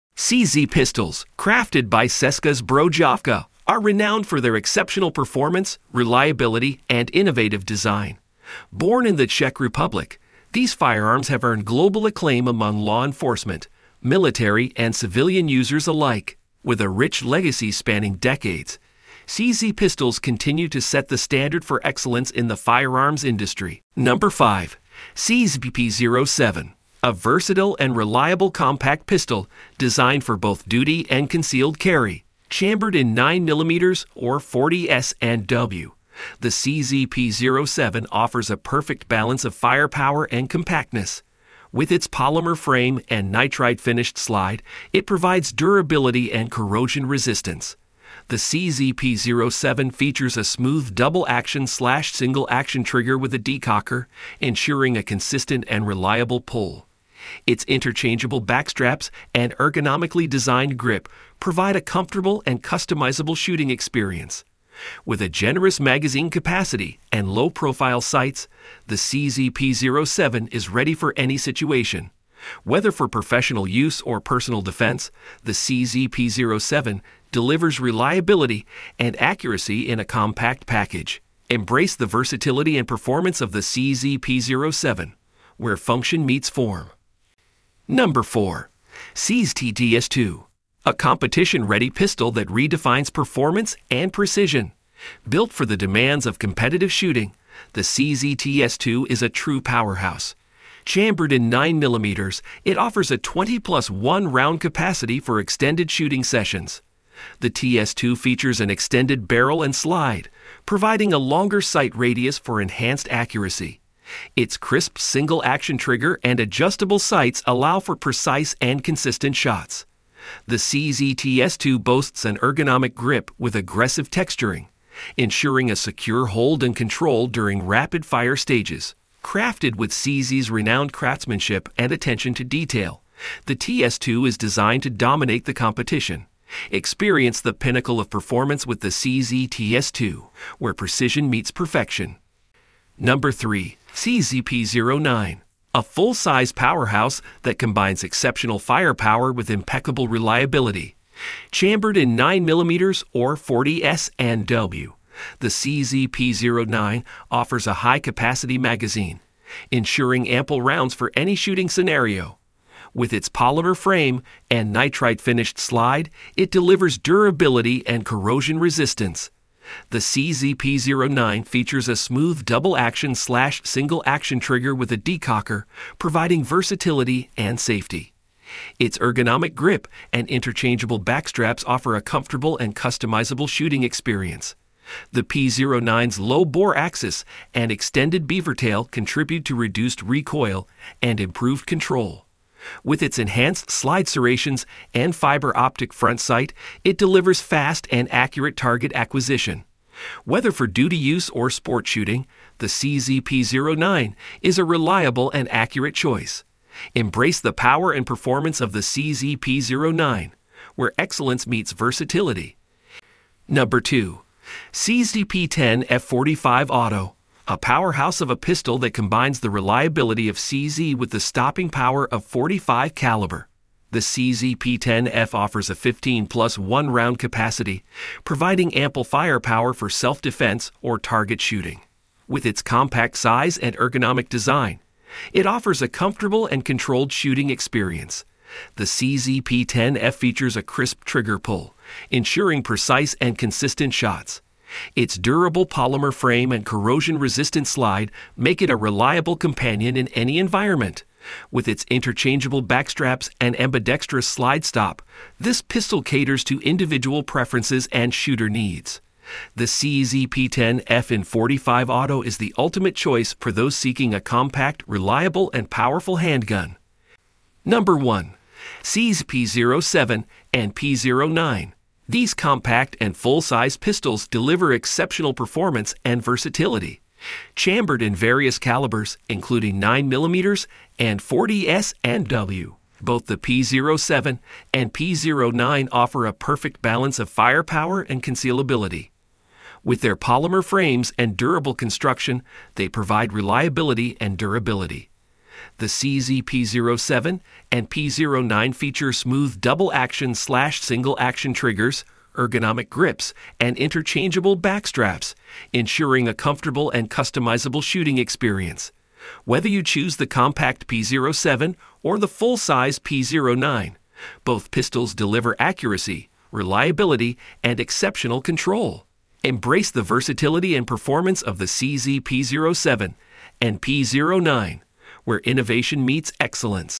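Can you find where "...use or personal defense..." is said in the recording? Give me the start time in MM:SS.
01:13.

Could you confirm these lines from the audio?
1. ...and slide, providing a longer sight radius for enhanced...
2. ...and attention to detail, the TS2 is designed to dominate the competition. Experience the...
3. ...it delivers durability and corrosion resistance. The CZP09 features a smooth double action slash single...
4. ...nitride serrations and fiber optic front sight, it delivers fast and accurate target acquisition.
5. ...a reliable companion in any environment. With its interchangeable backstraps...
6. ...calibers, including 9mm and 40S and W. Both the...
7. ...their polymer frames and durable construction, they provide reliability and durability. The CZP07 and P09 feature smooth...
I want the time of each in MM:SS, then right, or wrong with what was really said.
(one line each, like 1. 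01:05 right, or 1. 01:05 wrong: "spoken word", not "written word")
1. 01:49 right
2. 02:11 right
3. 02:46 right
4. 03:13 wrong: "slide", not "nitride"
5. 04:08 right
6. 04:38 right
7. 04:50 right.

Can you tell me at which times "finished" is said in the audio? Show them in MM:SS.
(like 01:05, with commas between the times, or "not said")
00:43, 02:45.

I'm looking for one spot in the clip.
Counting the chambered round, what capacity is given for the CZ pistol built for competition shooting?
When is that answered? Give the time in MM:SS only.
01:43.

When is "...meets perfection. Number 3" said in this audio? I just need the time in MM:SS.
02:21.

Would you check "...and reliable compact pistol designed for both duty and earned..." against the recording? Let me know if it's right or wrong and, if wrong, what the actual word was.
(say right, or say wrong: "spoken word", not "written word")
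wrong: "concealed", not "earned".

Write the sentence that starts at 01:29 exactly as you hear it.
CZ 2 a competition-ready pistol that redefines performance and precision.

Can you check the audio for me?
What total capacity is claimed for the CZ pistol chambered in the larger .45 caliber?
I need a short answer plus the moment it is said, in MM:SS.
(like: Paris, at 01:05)
15+1, at 03:45.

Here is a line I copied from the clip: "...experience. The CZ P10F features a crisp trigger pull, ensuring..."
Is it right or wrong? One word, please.
right.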